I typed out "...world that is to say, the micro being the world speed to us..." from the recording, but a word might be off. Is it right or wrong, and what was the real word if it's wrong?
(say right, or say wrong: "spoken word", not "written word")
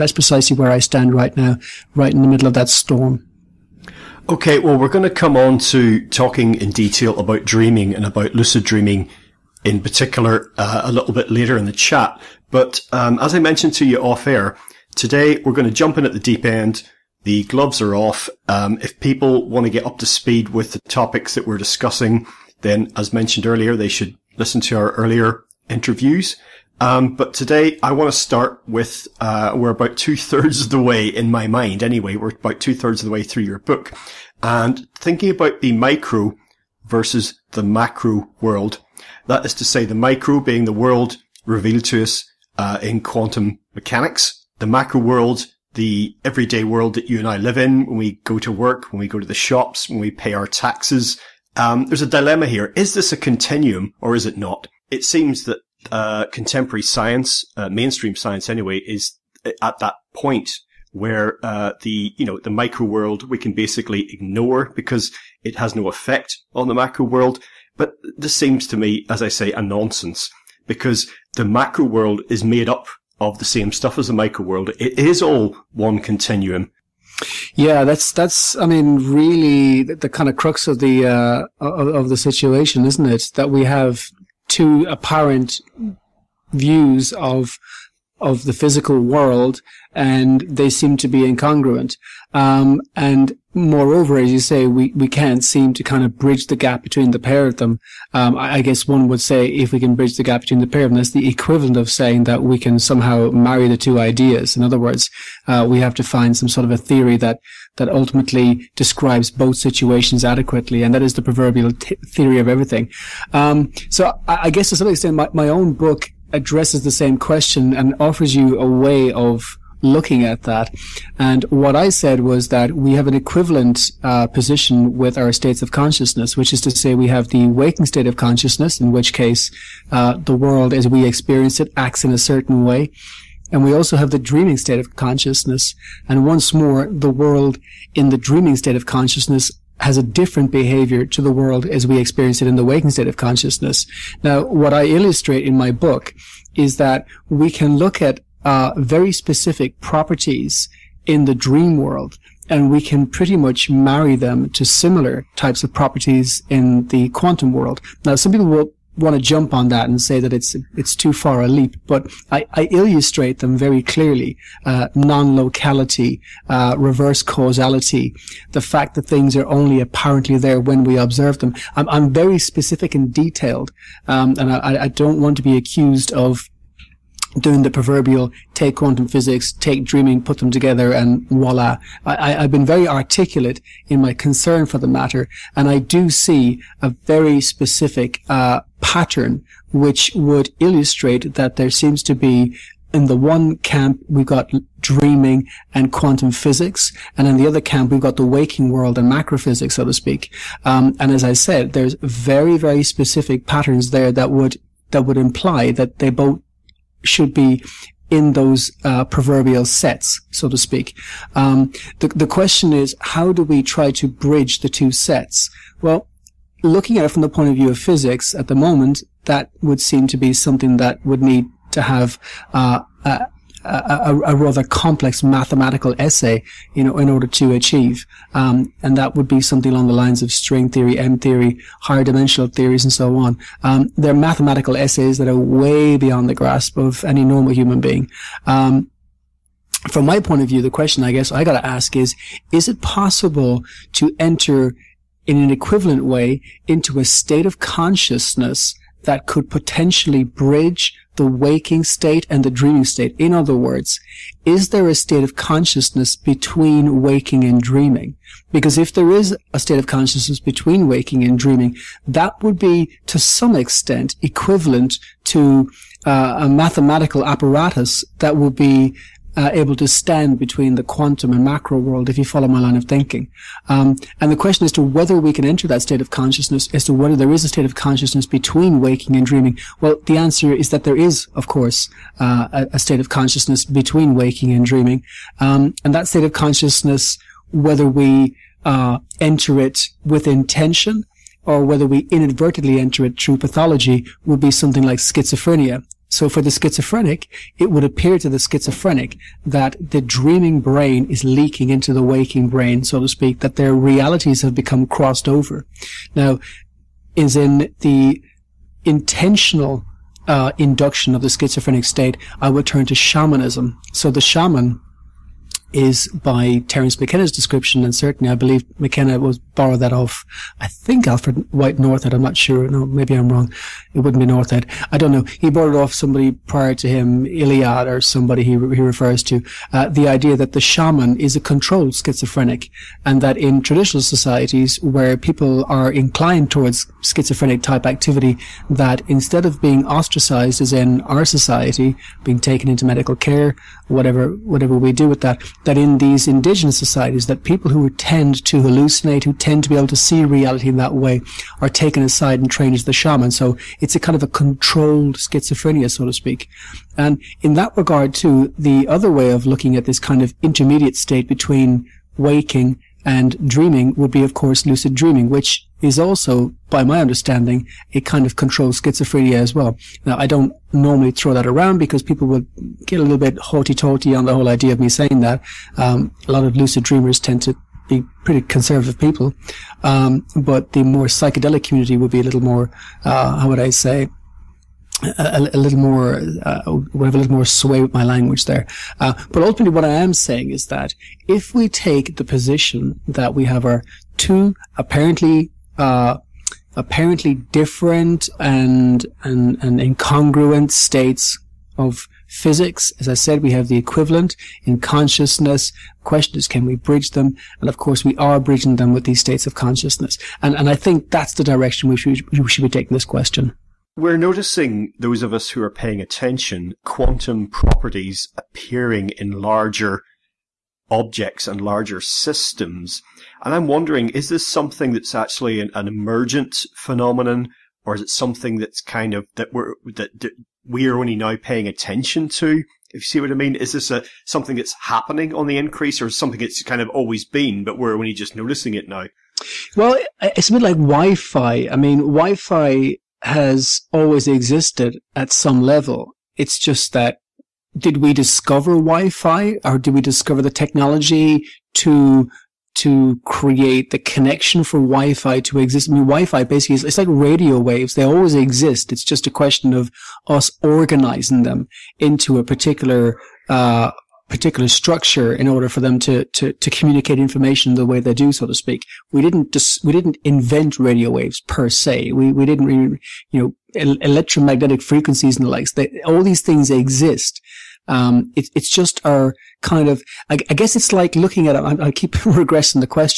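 wrong: "revealed", not "speed".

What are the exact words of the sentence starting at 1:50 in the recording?
And that is the proverbial t- theory of everything.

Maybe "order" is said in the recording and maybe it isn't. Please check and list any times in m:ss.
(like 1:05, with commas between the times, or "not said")
3:47, 7:45.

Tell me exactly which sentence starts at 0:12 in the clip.
But um, as I mentioned to you off air, today we're going to jump in at the deep end.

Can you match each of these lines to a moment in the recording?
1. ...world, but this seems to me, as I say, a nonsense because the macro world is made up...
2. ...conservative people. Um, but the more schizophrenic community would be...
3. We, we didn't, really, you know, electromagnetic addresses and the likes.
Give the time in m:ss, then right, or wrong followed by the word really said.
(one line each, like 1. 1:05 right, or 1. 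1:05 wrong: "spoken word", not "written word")
1. 1:07 right
2. 6:18 wrong: "psychedelic", not "schizophrenic"
3. 7:52 wrong: "frequencies", not "addresses".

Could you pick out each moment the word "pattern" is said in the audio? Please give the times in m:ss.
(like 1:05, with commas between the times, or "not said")
3:08, 3:23.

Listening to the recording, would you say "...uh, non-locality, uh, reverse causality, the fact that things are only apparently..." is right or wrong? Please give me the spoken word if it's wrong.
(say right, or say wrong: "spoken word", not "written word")
right.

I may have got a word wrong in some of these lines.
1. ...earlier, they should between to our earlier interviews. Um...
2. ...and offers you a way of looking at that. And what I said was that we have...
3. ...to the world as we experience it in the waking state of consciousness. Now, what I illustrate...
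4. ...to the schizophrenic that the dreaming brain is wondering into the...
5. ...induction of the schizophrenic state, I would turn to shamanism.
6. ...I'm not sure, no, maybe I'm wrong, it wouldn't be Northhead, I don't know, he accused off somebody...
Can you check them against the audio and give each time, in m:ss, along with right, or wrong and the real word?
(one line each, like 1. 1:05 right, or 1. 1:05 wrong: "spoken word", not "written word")
1. 0:23 wrong: "listen", not "between"
2. 1:57 right
3. 2:21 right
4. 4:58 wrong: "leaking", not "wondering"
5. 5:10 right
6. 5:22 wrong: "borrowed", not "accused".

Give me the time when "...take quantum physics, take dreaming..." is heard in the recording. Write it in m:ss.
2:58.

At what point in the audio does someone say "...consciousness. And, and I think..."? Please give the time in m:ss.
6:49.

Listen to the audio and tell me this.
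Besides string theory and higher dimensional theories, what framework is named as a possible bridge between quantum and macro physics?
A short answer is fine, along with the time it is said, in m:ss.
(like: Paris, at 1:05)
M theory, at 3:50.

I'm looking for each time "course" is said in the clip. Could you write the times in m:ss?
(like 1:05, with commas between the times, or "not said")
4:41, 6:04, 6:47.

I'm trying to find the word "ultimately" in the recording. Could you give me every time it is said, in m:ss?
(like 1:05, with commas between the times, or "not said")
1:47, 6:29.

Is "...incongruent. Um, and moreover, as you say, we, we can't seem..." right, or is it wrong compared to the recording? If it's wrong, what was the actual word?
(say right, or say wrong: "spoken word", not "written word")
right.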